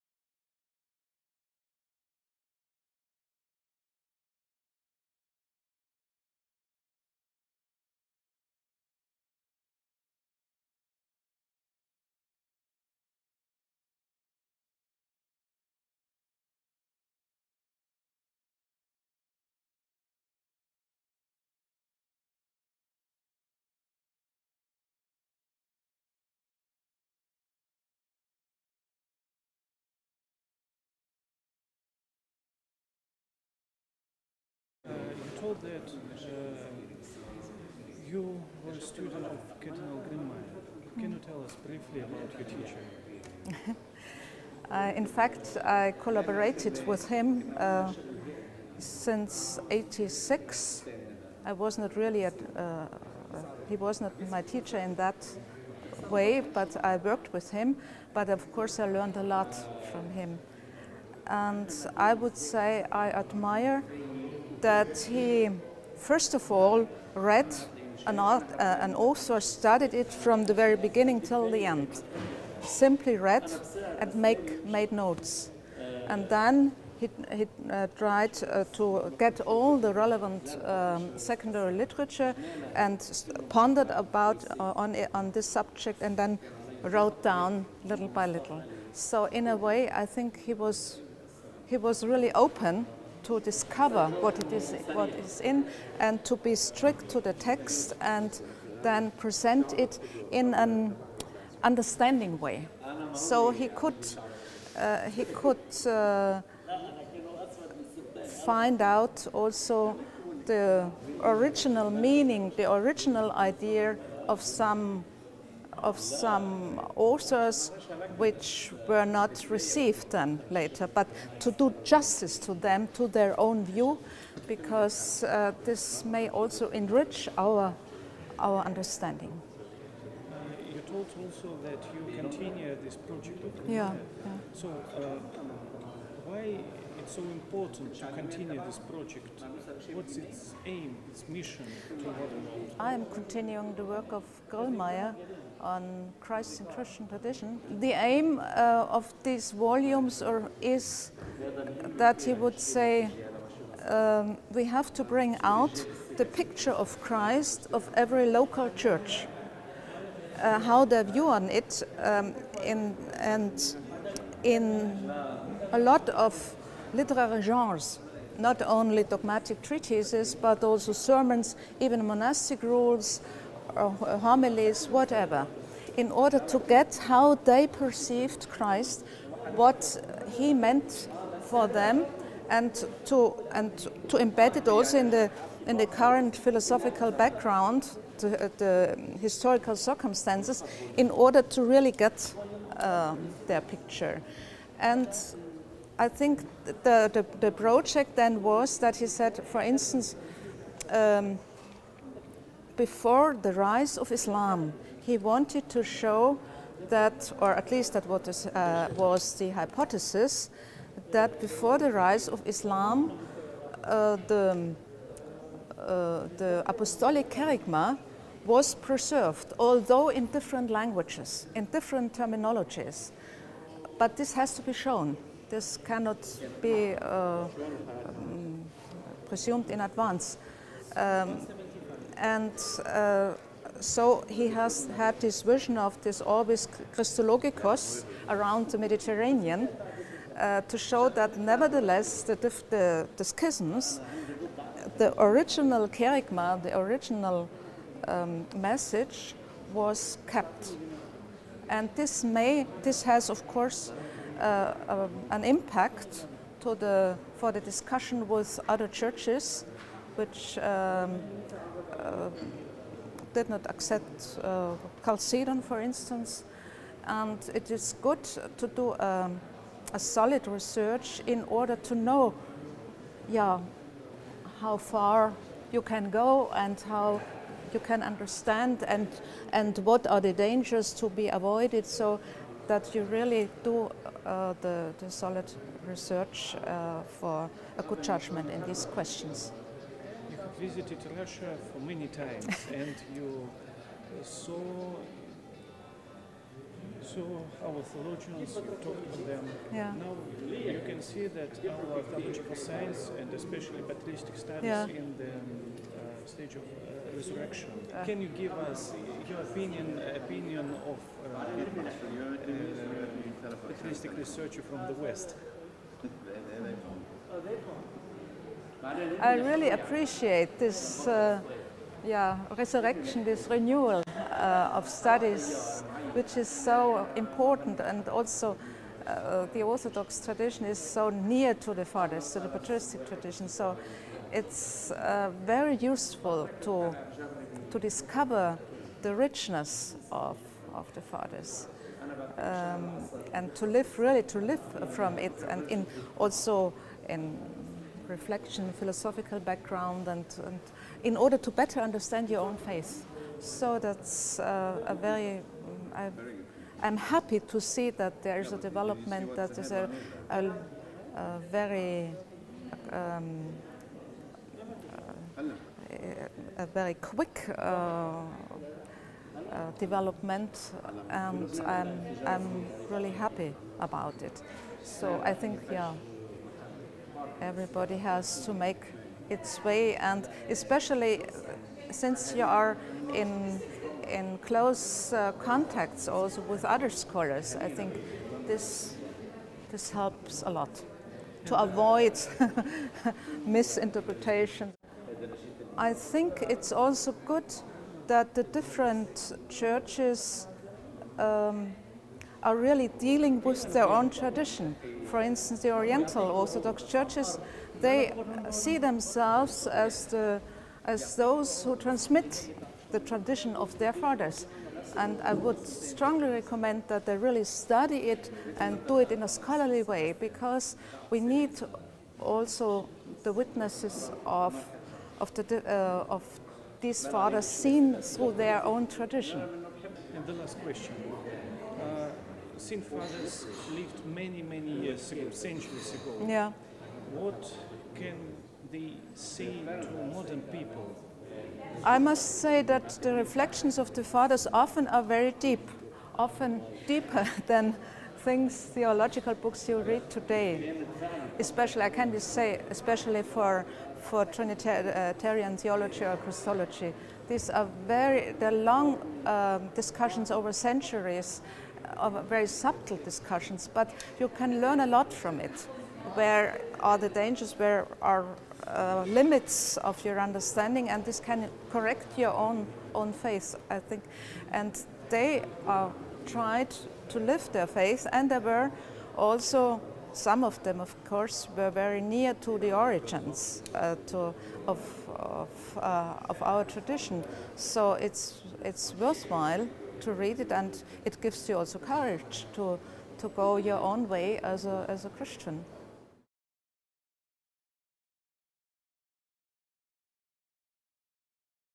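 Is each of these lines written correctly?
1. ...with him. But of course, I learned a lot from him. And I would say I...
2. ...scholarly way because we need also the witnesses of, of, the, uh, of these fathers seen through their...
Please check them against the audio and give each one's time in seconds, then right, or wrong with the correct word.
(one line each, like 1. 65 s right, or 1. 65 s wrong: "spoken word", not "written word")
1. 57 s right
2. 419 s right.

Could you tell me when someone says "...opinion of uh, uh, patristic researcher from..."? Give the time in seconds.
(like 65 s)
310 s.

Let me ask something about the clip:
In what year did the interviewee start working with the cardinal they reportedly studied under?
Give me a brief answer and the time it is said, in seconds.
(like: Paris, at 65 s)
1986, at 49 s.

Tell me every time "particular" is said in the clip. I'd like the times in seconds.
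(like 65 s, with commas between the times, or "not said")
not said.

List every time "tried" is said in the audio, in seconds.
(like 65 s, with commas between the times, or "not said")
77 s, 476 s.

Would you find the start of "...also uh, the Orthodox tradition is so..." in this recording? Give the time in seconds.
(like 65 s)
328 s.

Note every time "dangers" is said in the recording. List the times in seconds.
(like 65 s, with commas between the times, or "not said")
280 s, 467 s.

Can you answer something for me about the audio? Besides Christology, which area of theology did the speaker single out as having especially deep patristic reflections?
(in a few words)
Trinitarian theology.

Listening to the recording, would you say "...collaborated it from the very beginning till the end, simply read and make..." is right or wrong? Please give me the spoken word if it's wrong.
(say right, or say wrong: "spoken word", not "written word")
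wrong: "studied", not "collaborated".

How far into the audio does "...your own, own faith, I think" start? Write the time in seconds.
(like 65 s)
472 s.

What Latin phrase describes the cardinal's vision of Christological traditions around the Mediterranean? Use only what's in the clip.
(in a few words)
Orbis Christologikos.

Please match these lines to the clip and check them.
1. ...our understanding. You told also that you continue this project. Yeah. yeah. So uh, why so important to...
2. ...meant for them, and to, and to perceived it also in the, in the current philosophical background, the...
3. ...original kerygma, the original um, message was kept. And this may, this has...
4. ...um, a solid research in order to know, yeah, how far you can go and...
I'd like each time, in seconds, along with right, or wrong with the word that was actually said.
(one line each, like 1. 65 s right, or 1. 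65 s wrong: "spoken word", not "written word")
1. 128 s right
2. 180 s wrong: "embed", not "perceived"
3. 245 s right
4. 268 s right.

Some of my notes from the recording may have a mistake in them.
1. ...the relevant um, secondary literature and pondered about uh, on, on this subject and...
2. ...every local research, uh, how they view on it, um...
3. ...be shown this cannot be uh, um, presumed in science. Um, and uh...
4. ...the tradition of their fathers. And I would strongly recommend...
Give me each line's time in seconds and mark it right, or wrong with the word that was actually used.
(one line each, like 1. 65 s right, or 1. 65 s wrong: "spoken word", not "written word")
1. 79 s right
2. 157 s wrong: "church", not "research"
3. 224 s wrong: "advance", not "science"
4. 412 s right.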